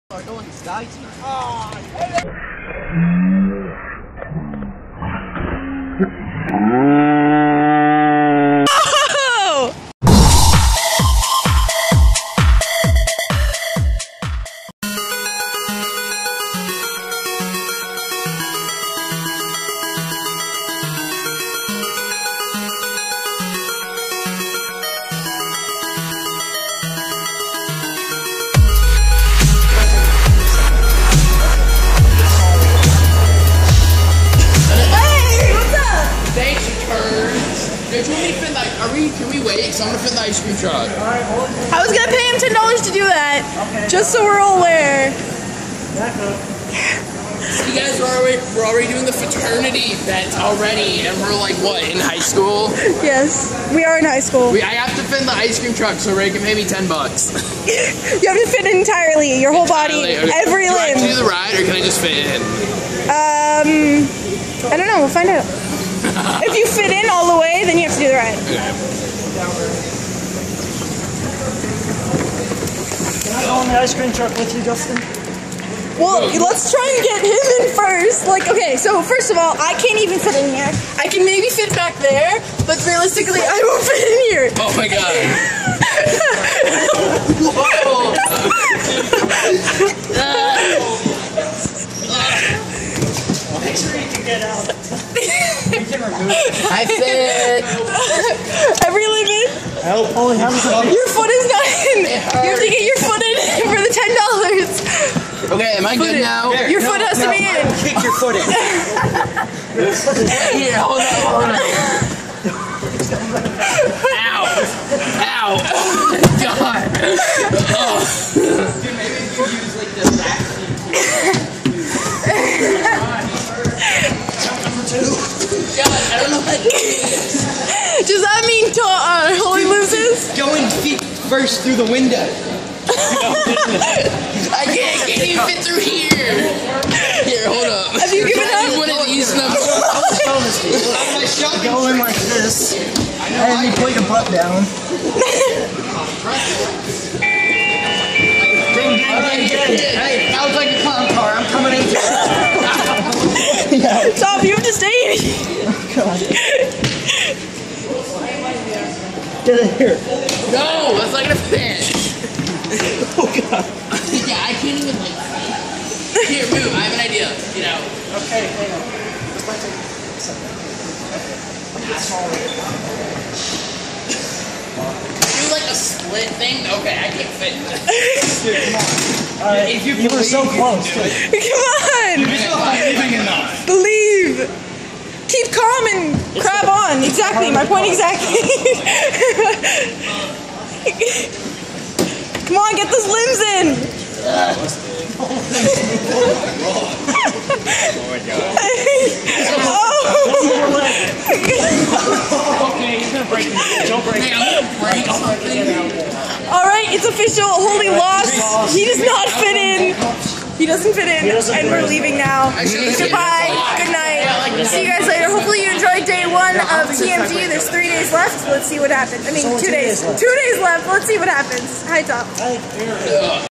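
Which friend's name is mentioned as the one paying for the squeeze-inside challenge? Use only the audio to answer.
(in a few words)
Ray.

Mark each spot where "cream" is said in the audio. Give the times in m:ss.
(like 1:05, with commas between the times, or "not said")
0:40, 0:55, 1:13.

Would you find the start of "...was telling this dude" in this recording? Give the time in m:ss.
2:20.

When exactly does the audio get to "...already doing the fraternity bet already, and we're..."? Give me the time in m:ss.
0:48.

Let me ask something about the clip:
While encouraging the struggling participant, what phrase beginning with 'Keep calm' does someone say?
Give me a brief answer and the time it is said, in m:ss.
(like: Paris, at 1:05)
Keep calm and crab on, at 3:05.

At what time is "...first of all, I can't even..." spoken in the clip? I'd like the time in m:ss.
1:19.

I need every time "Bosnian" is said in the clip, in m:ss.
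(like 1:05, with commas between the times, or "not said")
not said.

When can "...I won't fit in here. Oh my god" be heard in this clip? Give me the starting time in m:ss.
1:23.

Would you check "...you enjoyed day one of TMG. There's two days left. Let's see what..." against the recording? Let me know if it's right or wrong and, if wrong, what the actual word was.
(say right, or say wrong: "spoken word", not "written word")
wrong: "three", not "two".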